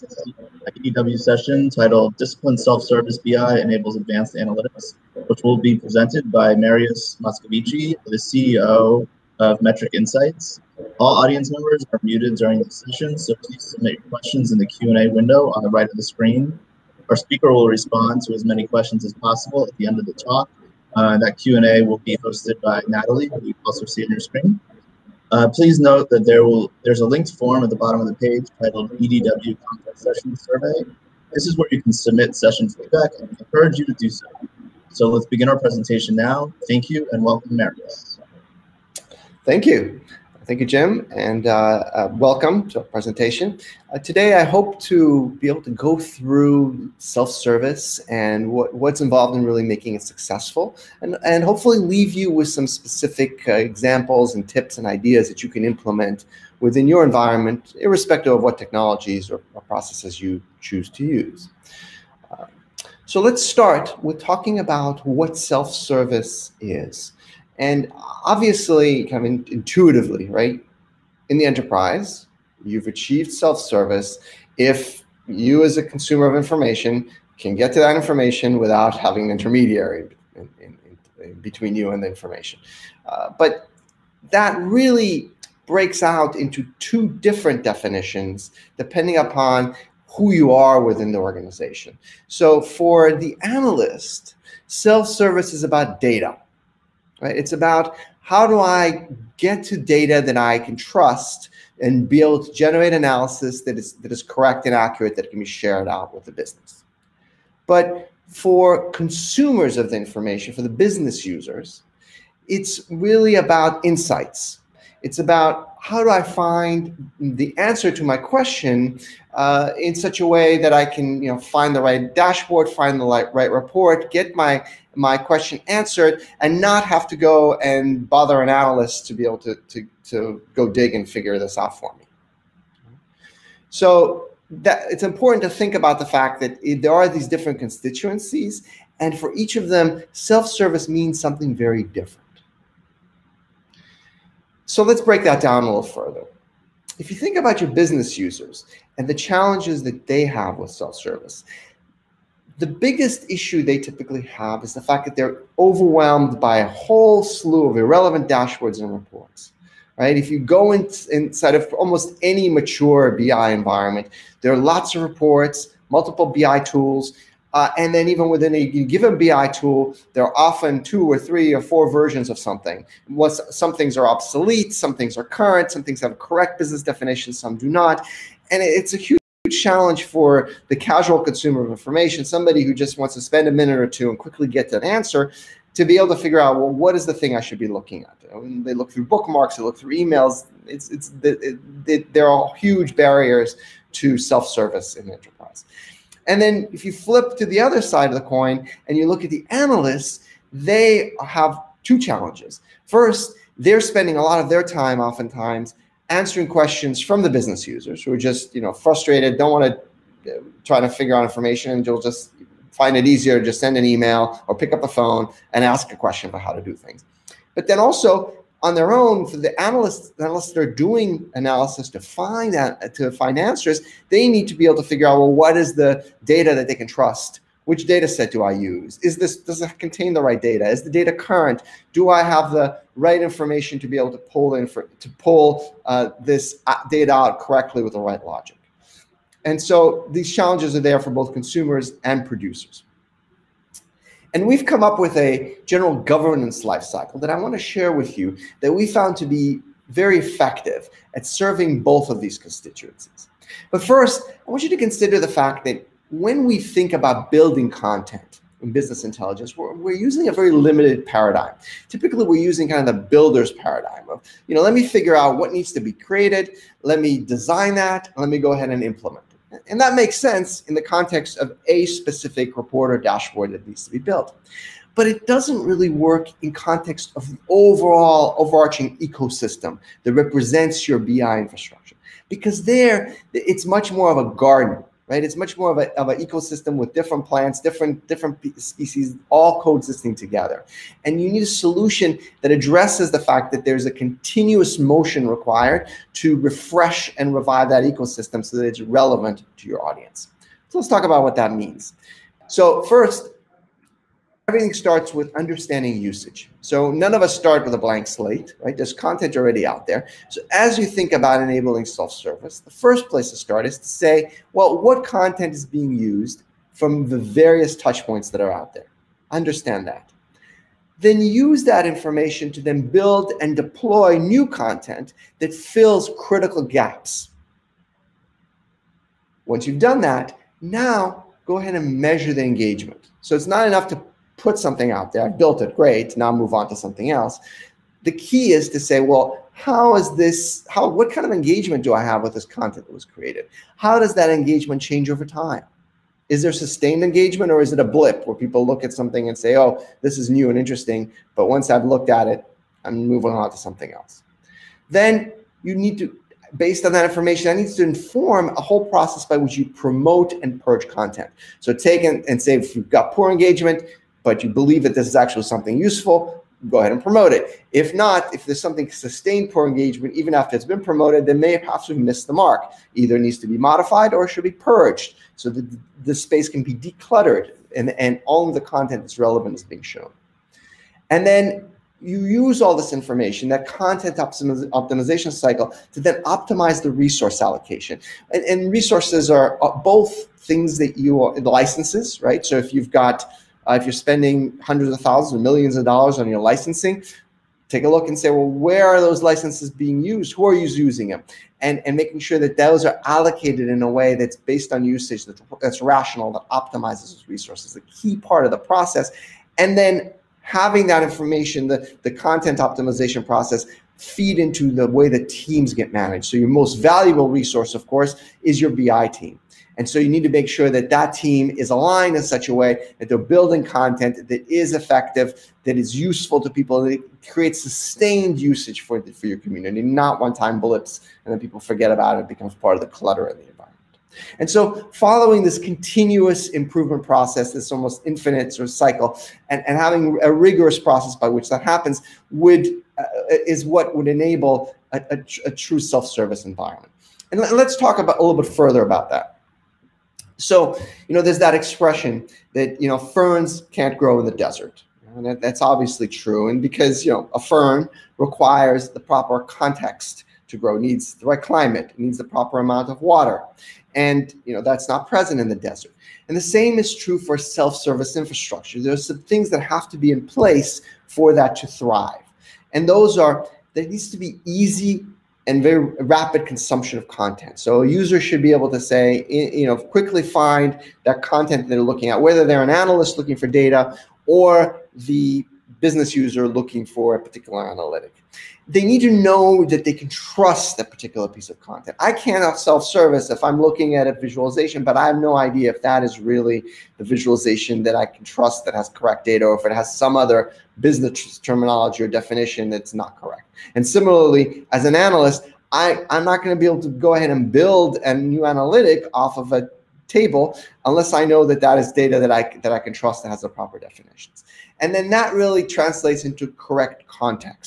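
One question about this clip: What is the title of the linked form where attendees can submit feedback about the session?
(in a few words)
EDW Content Session Survey.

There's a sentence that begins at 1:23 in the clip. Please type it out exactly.
Uh, but that really breaks out into two different definitions depending upon who you are within the organization.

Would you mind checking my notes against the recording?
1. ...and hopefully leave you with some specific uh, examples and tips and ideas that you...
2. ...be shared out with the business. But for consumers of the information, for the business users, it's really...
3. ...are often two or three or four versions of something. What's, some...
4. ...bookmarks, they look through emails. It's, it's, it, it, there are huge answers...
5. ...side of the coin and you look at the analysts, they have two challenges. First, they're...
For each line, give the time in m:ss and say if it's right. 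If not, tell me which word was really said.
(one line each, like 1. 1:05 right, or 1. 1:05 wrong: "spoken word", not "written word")
1. 0:51 right
2. 1:45 right
3. 2:50 right
4. 3:09 wrong: "barriers", not "answers"
5. 3:17 right.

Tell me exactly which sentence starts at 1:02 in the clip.
Uh, so let's start with talking about what self-service is.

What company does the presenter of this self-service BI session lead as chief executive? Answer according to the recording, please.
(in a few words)
Metric Insights.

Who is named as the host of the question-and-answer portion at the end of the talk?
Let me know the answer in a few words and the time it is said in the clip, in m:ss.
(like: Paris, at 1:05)
Natalie, at 0:22.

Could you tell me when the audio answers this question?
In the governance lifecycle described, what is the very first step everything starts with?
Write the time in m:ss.
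5:05.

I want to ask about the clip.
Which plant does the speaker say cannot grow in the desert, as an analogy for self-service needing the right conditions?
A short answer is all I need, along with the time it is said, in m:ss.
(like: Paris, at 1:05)
Ferns, at 7:32.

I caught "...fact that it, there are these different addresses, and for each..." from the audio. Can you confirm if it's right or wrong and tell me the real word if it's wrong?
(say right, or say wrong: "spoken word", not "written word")
wrong: "constituencies", not "addresses".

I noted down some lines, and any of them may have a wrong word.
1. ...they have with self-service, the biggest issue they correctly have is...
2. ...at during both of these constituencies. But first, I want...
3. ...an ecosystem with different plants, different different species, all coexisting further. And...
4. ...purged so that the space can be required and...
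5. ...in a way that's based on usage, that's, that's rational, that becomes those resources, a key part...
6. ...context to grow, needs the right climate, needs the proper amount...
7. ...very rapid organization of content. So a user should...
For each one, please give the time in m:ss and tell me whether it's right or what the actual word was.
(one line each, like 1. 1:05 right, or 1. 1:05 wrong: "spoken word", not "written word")
1. 2:30 wrong: "typically", not "correctly"
2. 4:11 wrong: "serving", not "during"
3. 4:46 wrong: "together", not "further"
4. 6:14 wrong: "decluttered", not "required"
5. 6:43 wrong: "optimizes", not "becomes"
6. 7:39 right
7. 7:55 wrong: "consumption", not "organization".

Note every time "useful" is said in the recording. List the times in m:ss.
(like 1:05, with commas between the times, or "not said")
6:05, 7:05.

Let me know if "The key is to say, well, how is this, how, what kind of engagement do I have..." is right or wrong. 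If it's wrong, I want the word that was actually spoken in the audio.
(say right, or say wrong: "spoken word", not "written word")
right.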